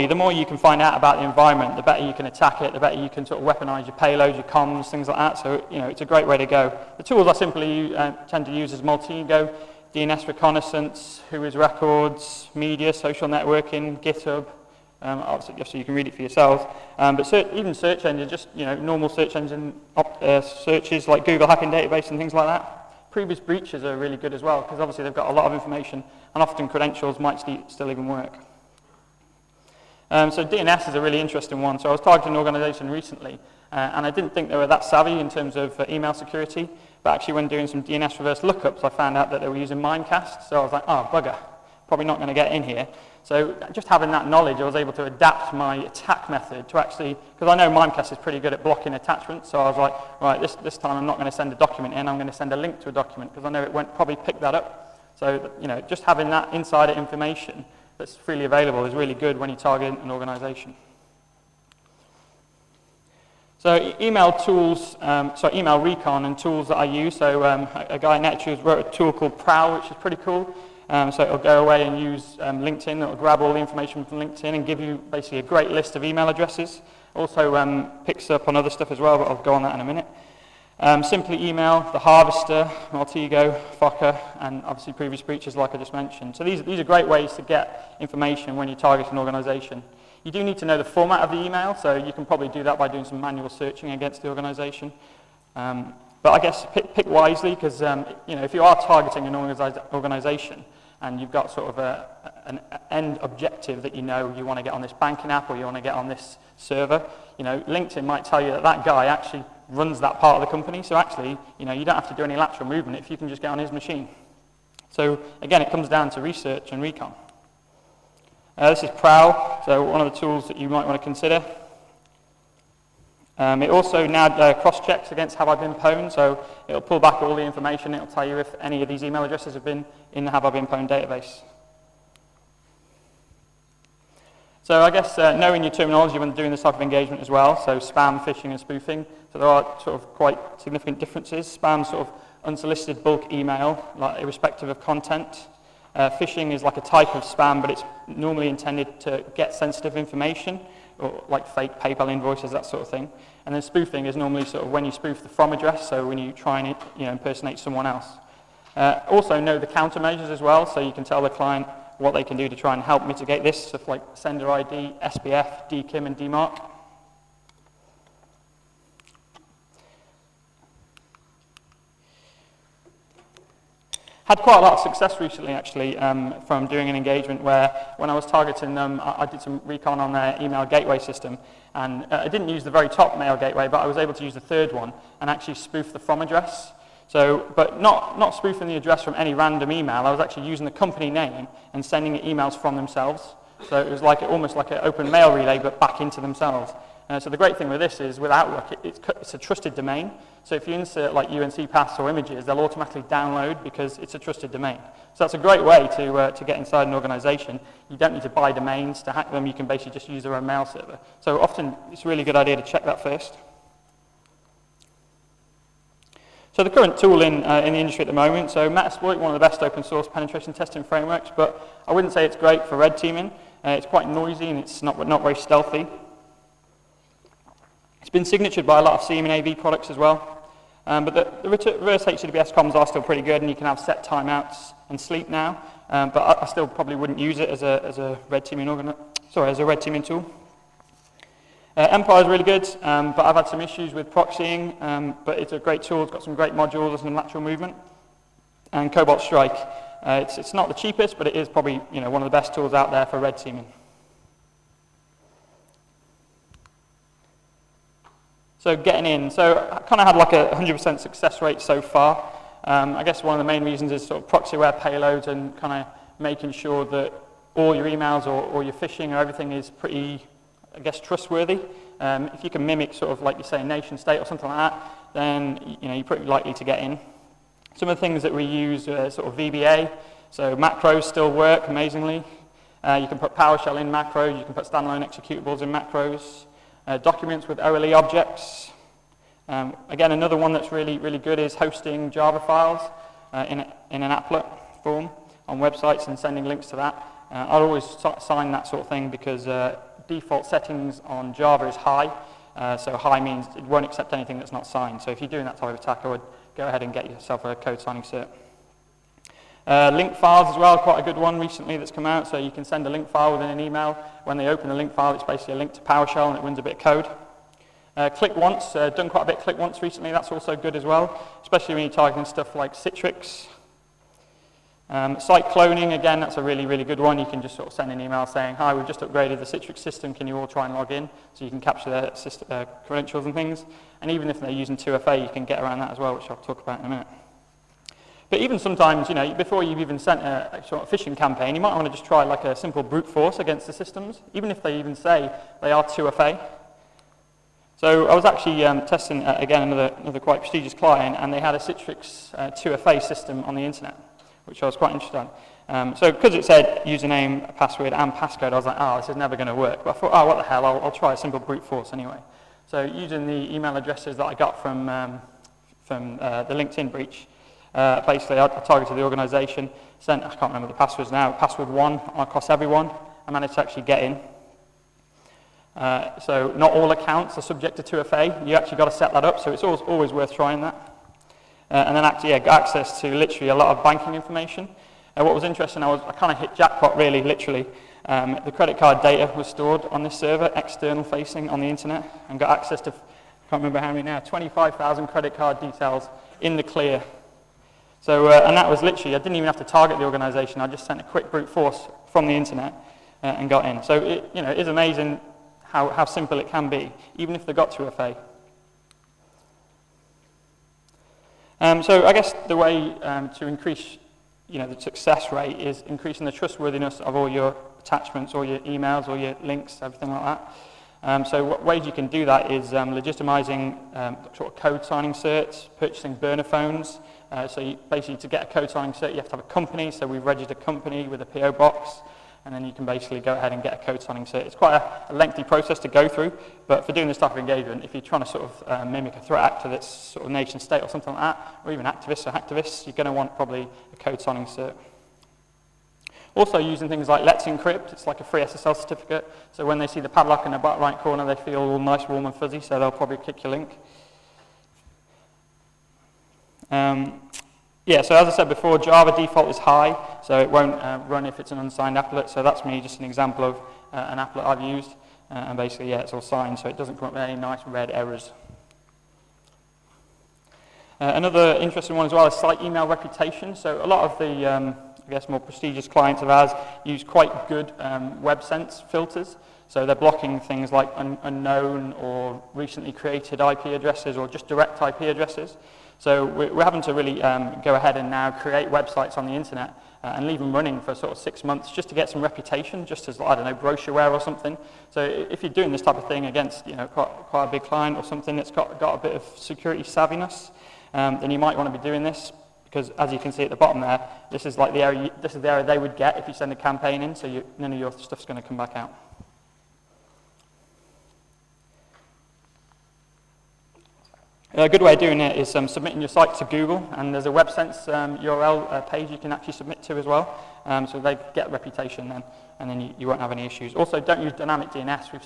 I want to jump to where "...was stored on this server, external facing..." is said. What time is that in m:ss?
6:29.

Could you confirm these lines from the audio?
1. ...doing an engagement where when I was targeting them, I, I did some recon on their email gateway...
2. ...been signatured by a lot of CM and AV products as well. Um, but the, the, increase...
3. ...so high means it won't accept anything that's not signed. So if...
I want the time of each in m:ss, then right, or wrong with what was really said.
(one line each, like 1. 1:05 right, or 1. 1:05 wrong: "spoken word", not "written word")
1. 2:56 right
2. 3:48 wrong: "reverse", not "increase"
3. 5:02 right.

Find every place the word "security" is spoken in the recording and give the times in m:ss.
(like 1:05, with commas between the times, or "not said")
0:36, 8:19.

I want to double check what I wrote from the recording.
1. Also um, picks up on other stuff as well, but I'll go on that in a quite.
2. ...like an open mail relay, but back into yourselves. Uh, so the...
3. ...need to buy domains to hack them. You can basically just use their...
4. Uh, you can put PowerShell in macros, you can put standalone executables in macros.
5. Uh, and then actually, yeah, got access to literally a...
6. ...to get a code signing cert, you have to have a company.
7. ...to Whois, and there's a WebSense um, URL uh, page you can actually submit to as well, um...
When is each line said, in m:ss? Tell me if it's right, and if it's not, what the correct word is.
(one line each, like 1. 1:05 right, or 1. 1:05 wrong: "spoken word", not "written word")
1. 1:17 wrong: "minute", not "quite"
2. 3:14 wrong: "themselves", not "yourselves"
3. 3:28 right
4. 4:42 right
5. 6:21 right
6. 7:08 right
7. 8:36 wrong: "Google", not "Whois".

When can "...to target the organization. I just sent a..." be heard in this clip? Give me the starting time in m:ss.
6:39.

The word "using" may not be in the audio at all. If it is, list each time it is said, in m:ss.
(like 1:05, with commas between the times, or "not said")
0:39, 3:10, 5:34, 6:02, 7:26.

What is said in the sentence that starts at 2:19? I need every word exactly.
So there are sort of quite significant differences.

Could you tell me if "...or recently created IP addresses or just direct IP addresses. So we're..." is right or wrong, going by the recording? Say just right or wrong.
right.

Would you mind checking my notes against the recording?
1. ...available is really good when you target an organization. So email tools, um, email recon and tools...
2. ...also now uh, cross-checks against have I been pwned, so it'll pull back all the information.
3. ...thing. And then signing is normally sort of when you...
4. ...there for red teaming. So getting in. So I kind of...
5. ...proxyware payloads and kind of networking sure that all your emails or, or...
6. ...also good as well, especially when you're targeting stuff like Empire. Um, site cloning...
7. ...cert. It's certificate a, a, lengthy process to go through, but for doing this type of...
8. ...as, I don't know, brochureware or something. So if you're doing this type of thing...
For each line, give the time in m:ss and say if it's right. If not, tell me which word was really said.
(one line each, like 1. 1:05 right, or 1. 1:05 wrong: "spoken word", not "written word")
1. 0:58 right
2. 2:03 right
3. 2:32 wrong: "spoofing", not "signing"
4. 4:12 right
5. 4:24 wrong: "making", not "networking"
6. 5:20 wrong: "Citrix", not "Empire"
7. 7:14 wrong: "quite", not "certificate"
8. 8:13 right.